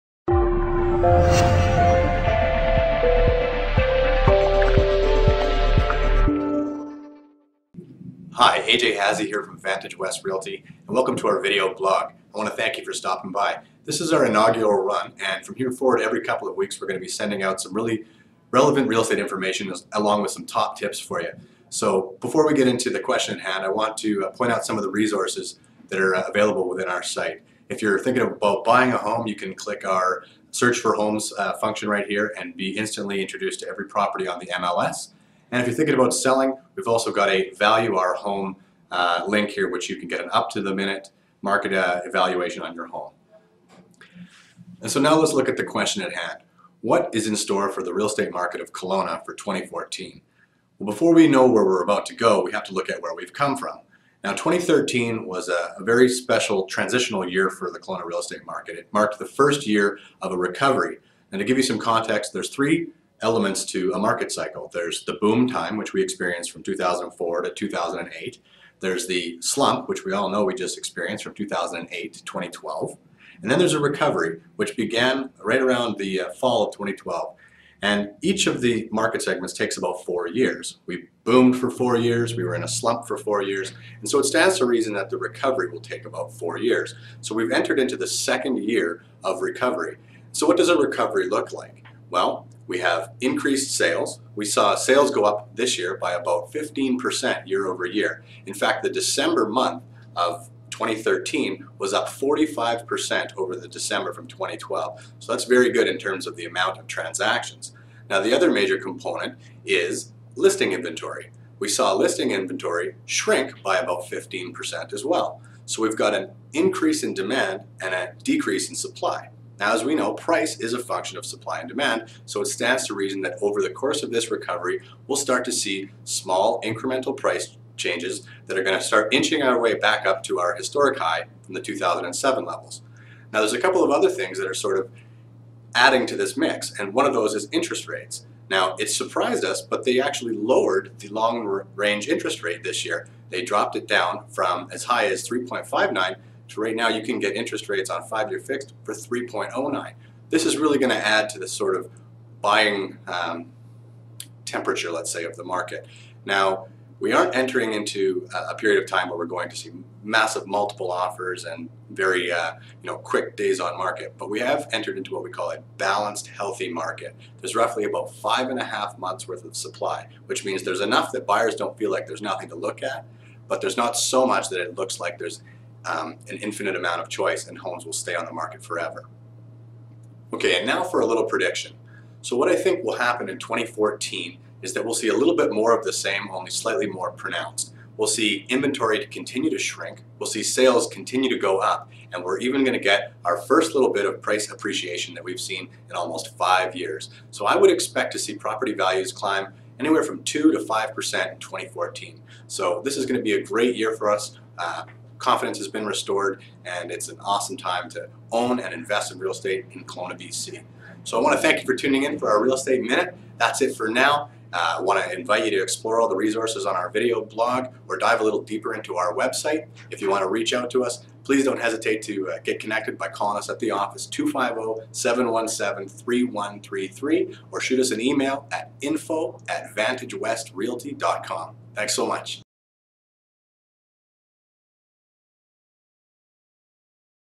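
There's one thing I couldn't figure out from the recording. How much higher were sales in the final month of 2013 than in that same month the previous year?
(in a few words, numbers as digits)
45%.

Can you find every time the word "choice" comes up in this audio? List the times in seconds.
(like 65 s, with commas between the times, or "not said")
177 s.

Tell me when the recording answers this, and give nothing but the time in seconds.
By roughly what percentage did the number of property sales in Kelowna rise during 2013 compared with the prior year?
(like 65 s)
96 s.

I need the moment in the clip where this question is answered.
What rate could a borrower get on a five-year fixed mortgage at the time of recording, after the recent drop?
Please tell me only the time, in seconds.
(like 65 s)
148 s.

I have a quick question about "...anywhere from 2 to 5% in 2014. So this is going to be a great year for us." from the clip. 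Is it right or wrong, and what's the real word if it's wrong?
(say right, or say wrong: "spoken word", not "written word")
right.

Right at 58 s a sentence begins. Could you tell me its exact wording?
It marked the first year of a recovery.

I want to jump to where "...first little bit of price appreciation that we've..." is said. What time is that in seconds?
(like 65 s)
193 s.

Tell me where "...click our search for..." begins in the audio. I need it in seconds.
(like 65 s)
29 s.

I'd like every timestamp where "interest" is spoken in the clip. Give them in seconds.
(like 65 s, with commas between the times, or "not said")
137 s, 142 s, 147 s.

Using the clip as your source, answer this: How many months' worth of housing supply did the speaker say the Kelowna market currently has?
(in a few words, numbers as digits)
5.5 months.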